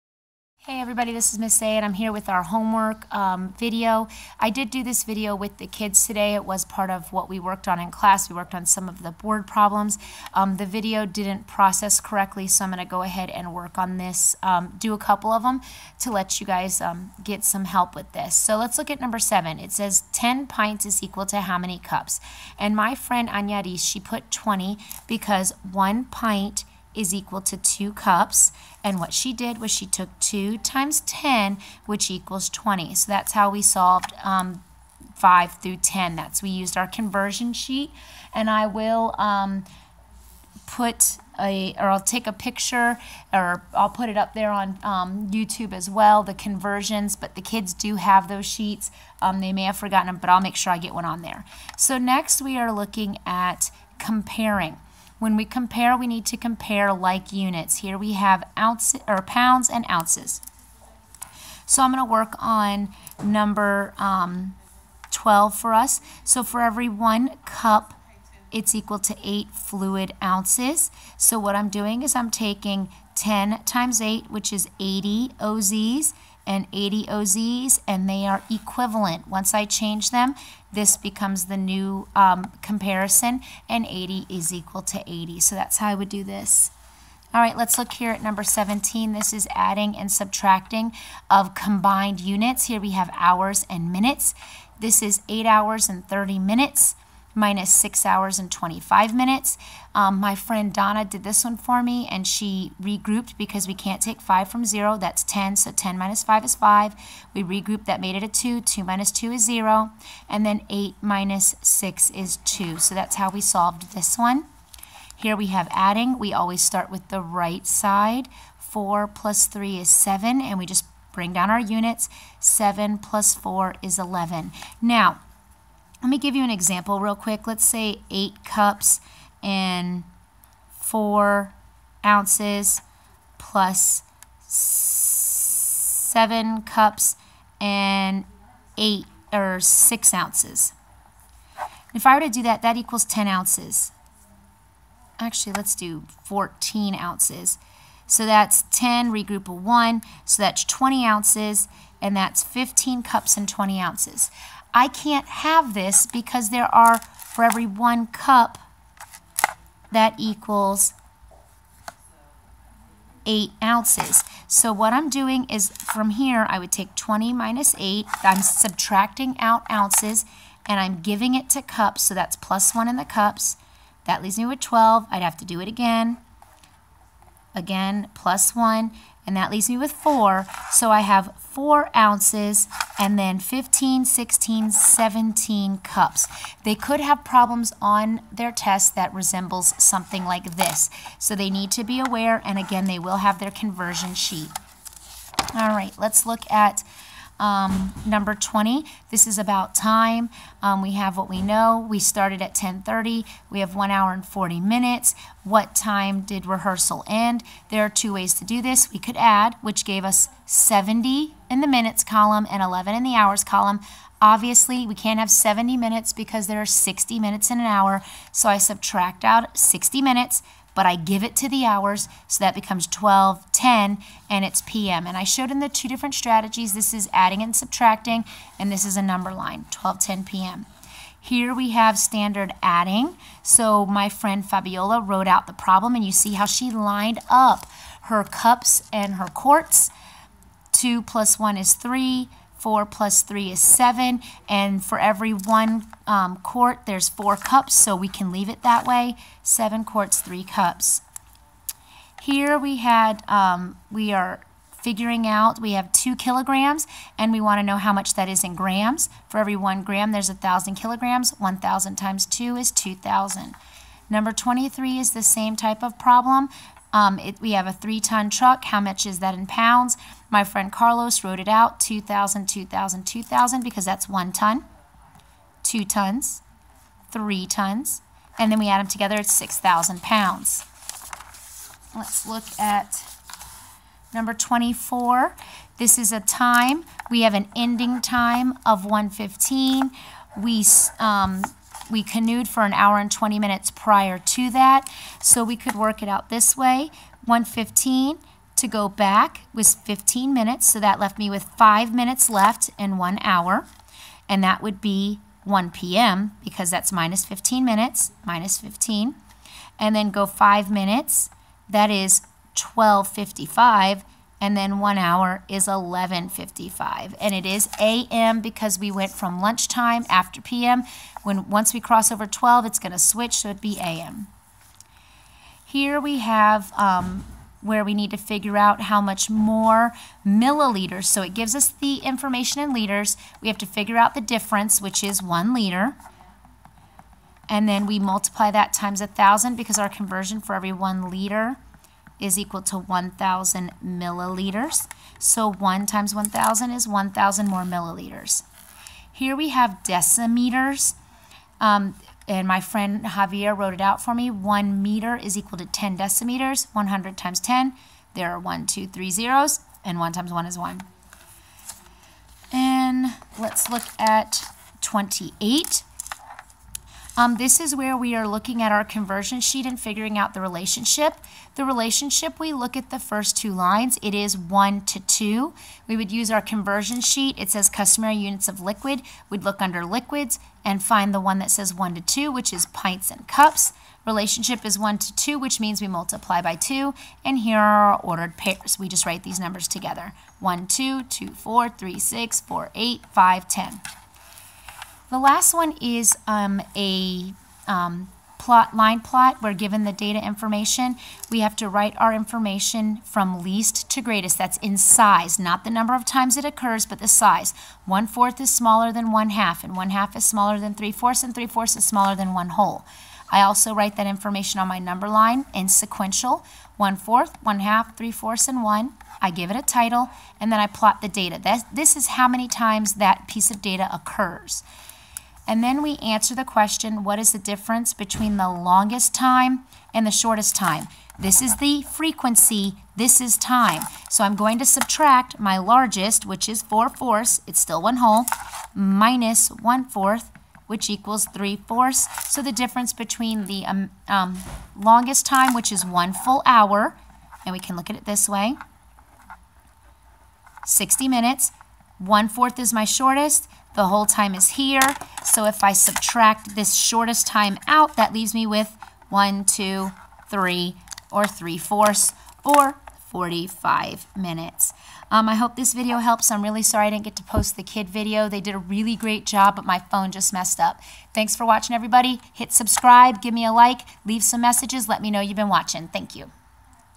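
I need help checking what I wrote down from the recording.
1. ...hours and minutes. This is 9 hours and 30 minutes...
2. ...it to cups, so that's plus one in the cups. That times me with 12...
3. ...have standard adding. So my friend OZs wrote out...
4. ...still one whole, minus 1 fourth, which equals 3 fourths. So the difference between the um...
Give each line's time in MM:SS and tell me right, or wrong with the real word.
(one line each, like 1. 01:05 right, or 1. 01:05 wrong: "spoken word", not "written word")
1. 01:33 wrong: "8", not "9"
2. 02:51 wrong: "leaves", not "times"
3. 03:51 wrong: "Fabiola", not "OZs"
4. 07:17 right.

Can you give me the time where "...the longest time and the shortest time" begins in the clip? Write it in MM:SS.
07:08.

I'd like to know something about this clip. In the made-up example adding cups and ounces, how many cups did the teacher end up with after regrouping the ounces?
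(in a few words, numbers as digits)
17.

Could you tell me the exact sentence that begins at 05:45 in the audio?
So 1 times 1,000 is 1,000 more milliliters.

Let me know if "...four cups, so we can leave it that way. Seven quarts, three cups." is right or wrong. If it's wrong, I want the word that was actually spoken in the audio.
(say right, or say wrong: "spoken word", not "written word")
right.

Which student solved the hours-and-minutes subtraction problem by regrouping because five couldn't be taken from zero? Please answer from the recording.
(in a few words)
Donna.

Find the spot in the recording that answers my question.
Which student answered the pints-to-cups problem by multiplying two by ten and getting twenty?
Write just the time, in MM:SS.
00:23.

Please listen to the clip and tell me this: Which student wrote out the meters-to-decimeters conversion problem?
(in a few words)
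Javier.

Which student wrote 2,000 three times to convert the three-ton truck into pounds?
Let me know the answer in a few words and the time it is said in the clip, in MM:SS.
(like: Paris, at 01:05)
Carlos, at 04:30.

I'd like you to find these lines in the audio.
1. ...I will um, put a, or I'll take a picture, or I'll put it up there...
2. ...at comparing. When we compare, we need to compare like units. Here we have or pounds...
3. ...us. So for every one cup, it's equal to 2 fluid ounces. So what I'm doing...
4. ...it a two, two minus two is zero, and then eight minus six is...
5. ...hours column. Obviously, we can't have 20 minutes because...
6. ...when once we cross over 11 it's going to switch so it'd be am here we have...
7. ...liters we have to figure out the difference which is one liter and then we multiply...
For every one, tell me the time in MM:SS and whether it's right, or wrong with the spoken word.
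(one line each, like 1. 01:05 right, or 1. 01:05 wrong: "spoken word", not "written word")
1. 00:38 right
2. 00:53 right
3. 01:05 wrong: "8", not "2"
4. 01:48 right
5. 03:33 wrong: "70", not "20"
6. 05:21 wrong: "12", not "11"
7. 05:32 right.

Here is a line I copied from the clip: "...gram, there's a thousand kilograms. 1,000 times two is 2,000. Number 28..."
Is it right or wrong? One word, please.
wrong.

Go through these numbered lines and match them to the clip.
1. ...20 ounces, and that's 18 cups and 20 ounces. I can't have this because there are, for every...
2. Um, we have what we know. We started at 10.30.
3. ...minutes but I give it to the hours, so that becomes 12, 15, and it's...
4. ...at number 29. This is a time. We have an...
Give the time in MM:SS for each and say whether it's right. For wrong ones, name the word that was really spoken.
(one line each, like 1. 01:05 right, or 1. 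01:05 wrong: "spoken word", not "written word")
1. 02:30 wrong: "15", not "18"
2. 03:20 right
3. 03:39 wrong: "10", not "15"
4. 04:42 wrong: "24", not "29".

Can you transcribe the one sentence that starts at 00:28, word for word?
And what she did was she took 2 times 10, which equals 20.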